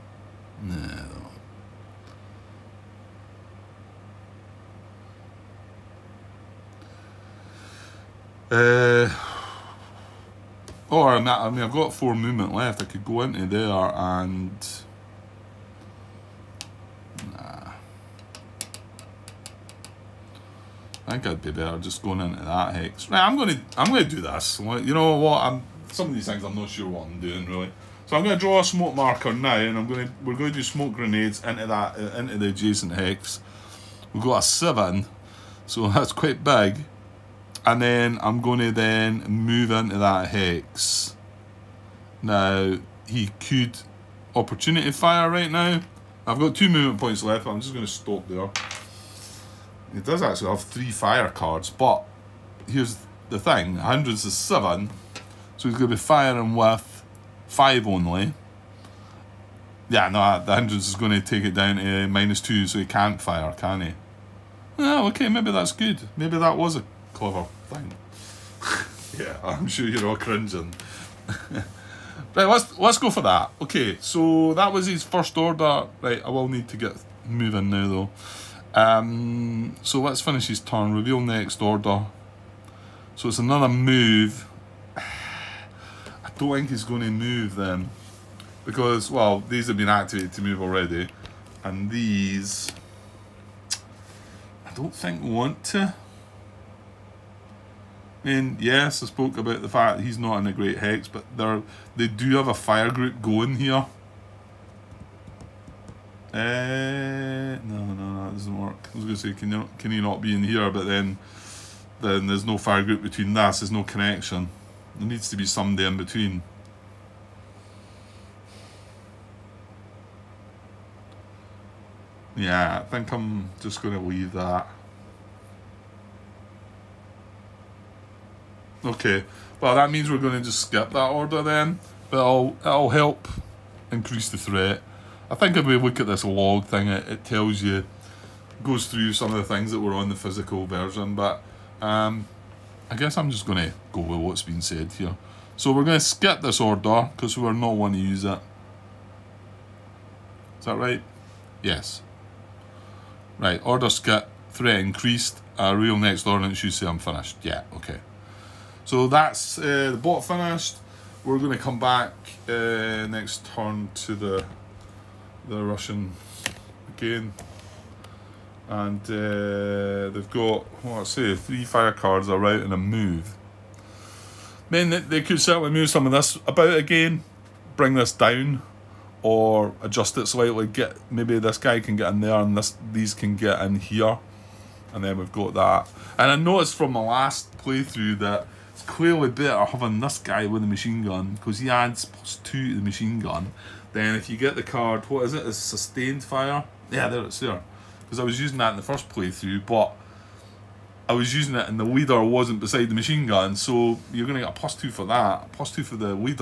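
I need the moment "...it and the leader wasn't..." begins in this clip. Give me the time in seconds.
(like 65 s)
201 s.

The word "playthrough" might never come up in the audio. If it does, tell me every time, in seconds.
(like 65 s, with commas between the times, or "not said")
187 s, 199 s.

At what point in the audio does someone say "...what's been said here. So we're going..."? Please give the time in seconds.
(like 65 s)
144 s.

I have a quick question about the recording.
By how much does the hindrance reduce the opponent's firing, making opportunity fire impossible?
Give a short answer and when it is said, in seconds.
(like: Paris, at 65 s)
minus 2, at 62 s.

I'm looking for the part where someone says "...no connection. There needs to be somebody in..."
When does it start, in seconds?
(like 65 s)
113 s.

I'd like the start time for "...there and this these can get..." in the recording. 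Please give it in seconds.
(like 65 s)
182 s.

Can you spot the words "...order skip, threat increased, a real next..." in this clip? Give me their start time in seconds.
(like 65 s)
153 s.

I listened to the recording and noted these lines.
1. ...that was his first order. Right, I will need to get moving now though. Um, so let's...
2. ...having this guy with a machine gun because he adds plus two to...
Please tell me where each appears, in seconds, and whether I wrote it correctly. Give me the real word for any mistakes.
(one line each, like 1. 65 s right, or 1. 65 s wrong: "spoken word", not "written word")
1. 74 s right
2. 189 s right.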